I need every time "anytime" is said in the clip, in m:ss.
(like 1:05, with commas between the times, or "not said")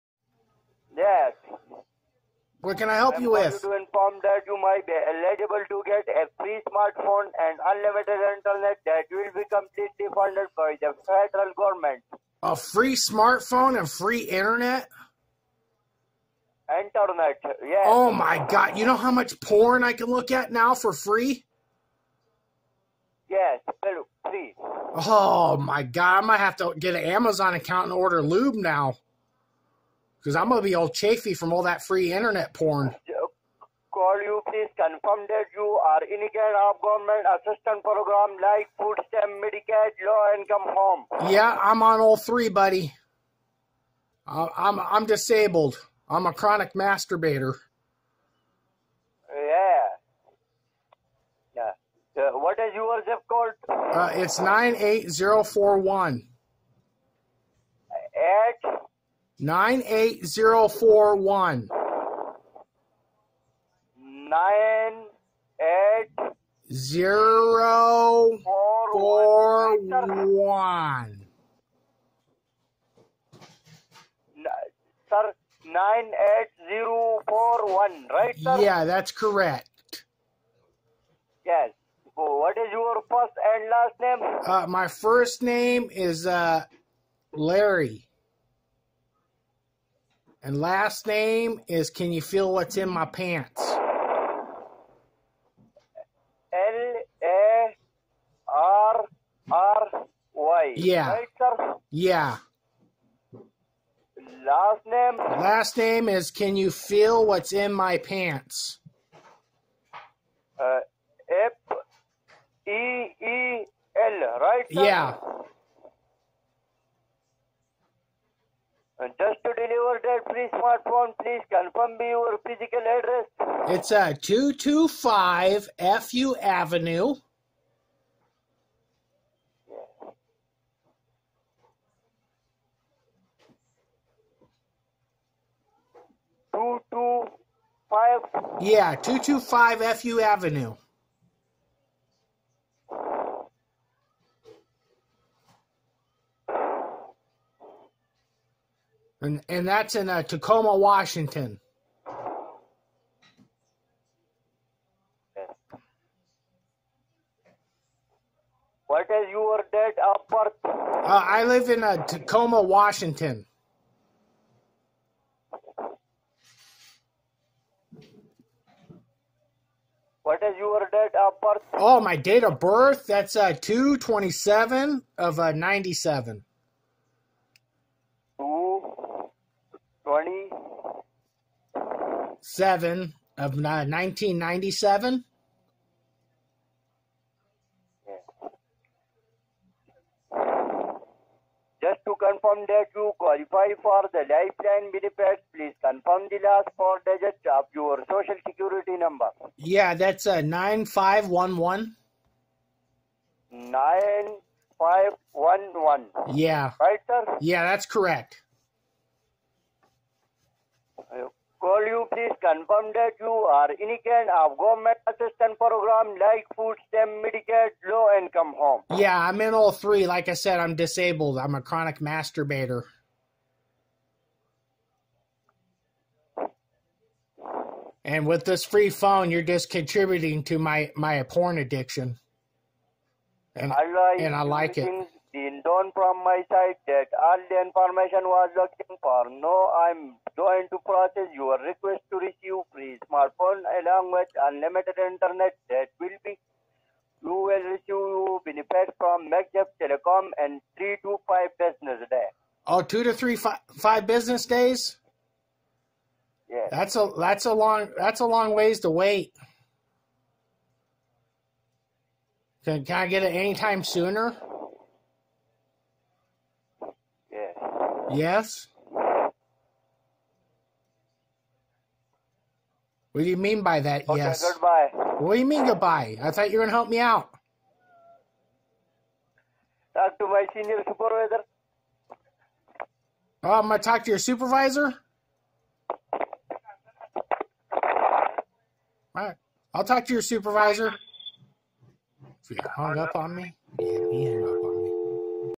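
4:23.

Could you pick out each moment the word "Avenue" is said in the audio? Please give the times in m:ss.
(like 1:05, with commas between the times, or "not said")
2:06, 2:20.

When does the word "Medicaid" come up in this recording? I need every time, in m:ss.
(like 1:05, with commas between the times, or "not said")
0:39, 3:37.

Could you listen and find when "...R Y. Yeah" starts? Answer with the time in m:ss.
1:39.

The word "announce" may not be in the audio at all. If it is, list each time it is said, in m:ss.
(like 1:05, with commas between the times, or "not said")
not said.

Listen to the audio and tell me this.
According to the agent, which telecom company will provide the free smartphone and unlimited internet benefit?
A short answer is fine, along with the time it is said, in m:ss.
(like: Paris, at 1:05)
Megjeff Telecom, at 4:09.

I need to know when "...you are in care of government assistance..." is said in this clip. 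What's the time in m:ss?
0:35.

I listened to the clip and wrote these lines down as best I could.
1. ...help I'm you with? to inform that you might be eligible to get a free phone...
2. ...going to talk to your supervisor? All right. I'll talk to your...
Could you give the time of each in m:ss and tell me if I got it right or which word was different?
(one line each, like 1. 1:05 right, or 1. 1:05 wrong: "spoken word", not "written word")
1. 0:02 wrong: "smartphone", not "phone"
2. 4:43 right.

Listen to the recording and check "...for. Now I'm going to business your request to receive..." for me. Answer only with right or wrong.
wrong.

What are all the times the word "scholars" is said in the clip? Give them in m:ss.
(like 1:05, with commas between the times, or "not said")
not said.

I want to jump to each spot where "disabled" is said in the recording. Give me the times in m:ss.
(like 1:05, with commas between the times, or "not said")
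0:45, 3:40.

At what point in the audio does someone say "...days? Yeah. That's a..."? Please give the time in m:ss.
4:14.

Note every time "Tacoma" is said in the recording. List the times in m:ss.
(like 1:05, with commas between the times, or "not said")
2:30, 2:42.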